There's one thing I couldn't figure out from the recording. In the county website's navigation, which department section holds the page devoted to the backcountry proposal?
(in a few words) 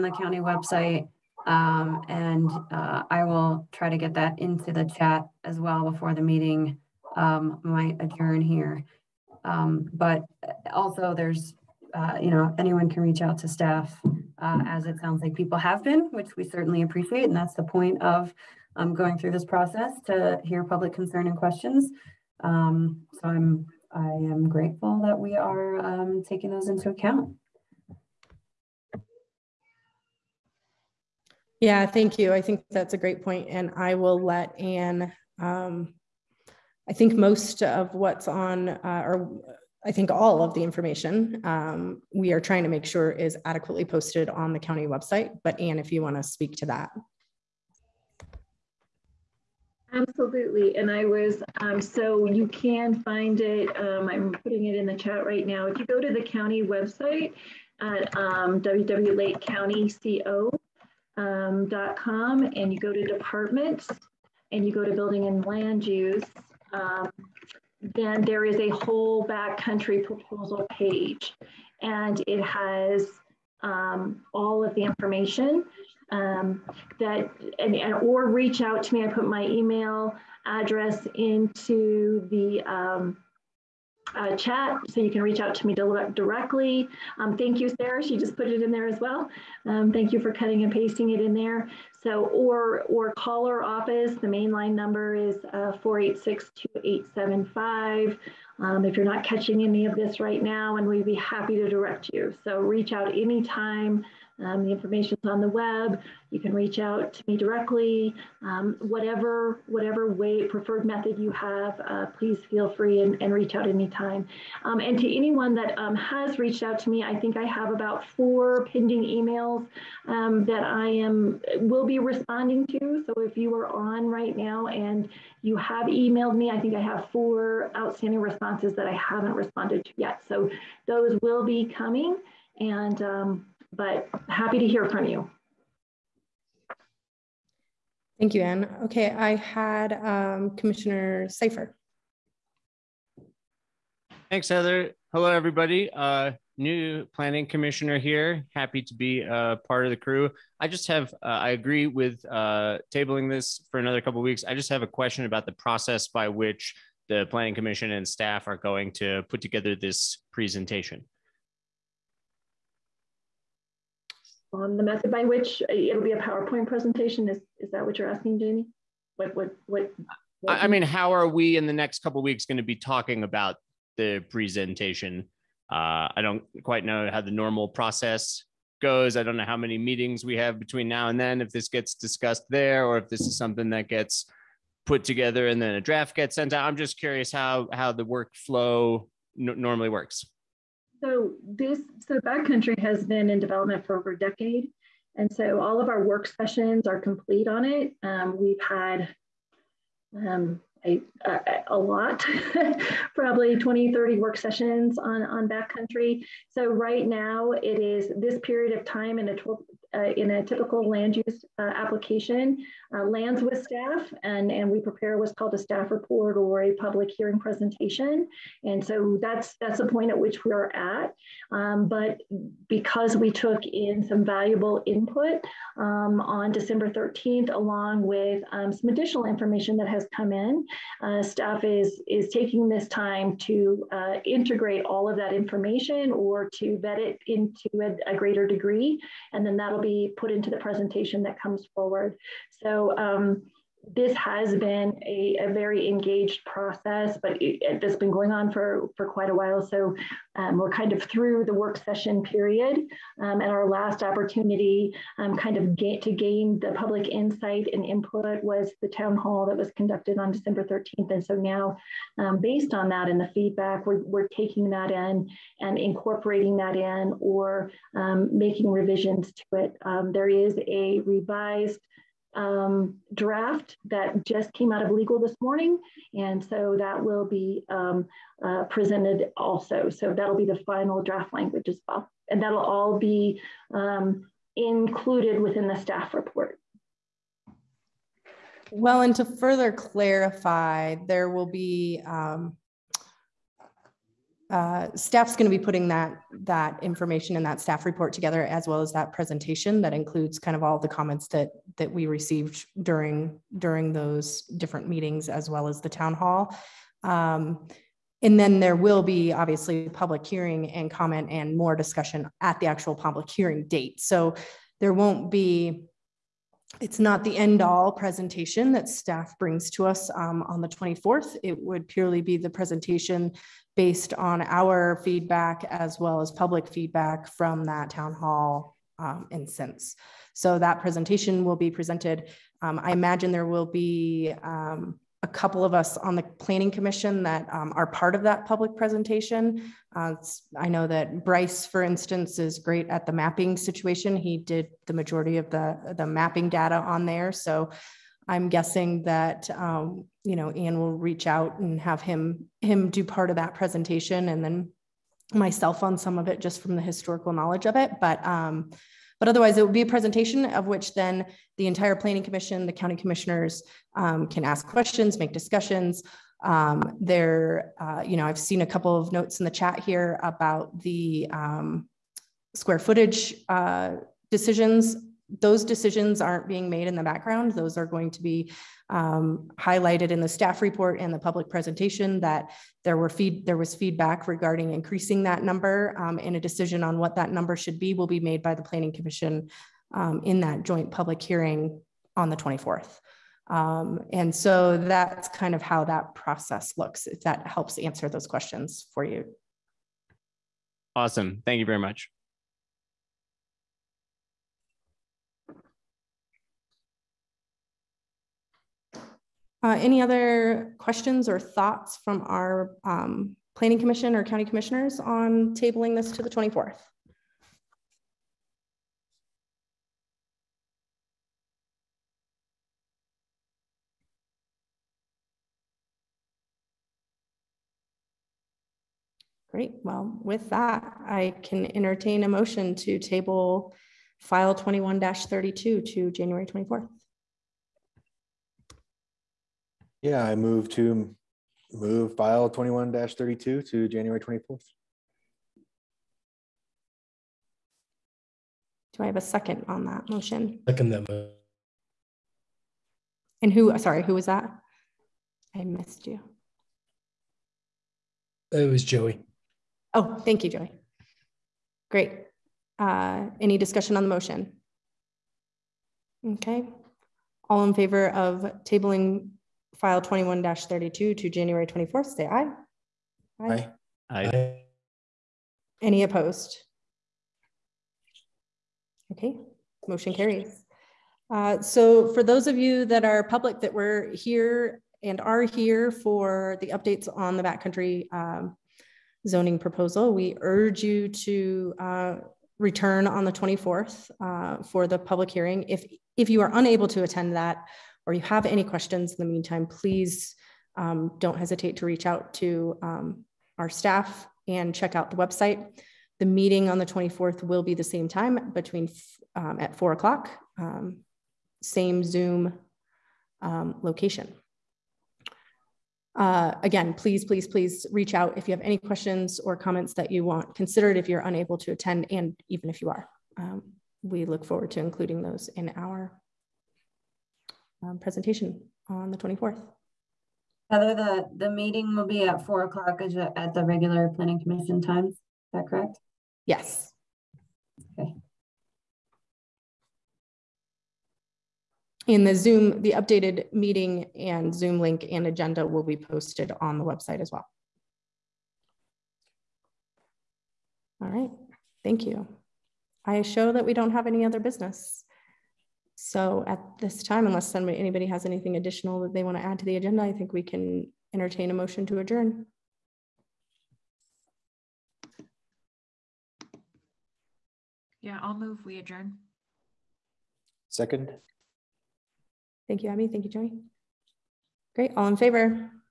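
Building and land use.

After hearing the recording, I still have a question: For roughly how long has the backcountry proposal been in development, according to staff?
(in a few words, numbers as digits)
Over a decade.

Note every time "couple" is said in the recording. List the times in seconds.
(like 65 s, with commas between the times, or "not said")
154 s, 172 s, 335 s, 368 s.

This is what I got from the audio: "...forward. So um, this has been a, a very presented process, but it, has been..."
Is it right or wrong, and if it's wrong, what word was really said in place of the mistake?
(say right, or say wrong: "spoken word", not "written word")
wrong: "engaged", not "presented".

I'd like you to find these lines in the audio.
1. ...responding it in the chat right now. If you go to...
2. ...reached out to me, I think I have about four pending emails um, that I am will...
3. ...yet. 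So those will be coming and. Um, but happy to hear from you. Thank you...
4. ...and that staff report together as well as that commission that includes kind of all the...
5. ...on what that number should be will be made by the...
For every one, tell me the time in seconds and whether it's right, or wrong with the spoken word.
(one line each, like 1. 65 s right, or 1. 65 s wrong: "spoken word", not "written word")
1. 54 s wrong: "putting", not "responding"
2. 116 s right
3. 129 s right
4. 297 s wrong: "presentation", not "commission"
5. 386 s right.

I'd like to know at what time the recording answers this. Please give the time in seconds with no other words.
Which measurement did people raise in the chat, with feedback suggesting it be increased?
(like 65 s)
372 s.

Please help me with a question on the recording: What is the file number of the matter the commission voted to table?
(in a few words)
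21-32.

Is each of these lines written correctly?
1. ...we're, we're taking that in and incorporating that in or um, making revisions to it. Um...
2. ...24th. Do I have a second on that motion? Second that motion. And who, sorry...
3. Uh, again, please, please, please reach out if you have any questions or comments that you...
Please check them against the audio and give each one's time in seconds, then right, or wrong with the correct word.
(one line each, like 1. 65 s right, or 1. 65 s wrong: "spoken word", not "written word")
1. 263 s right
2. 444 s right
3. 516 s right.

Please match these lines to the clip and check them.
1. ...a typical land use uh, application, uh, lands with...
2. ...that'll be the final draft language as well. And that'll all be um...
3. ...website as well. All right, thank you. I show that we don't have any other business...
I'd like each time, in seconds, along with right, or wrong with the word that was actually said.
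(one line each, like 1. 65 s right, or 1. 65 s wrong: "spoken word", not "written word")
1. 210 s right
2. 280 s right
3. 546 s right.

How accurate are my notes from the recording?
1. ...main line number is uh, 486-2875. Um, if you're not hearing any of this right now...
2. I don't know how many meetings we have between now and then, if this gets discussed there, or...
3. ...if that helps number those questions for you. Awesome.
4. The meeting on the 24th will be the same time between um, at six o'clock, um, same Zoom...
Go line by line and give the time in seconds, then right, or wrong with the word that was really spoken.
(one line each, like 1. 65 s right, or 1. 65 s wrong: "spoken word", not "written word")
1. 94 s wrong: "catching", not "hearing"
2. 179 s right
3. 397 s wrong: "answer", not "number"
4. 506 s wrong: "four", not "six".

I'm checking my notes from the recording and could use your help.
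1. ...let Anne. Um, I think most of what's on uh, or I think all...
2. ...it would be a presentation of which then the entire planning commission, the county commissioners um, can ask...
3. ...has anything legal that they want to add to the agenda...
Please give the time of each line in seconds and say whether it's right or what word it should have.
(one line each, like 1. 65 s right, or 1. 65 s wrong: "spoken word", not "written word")
1. 34 s right
2. 359 s right
3. 558 s wrong: "additional", not "legal".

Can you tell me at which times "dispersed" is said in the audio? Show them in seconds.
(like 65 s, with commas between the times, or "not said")
not said.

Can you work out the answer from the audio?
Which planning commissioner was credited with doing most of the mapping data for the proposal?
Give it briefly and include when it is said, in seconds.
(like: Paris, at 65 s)
Bryce, at 341 s.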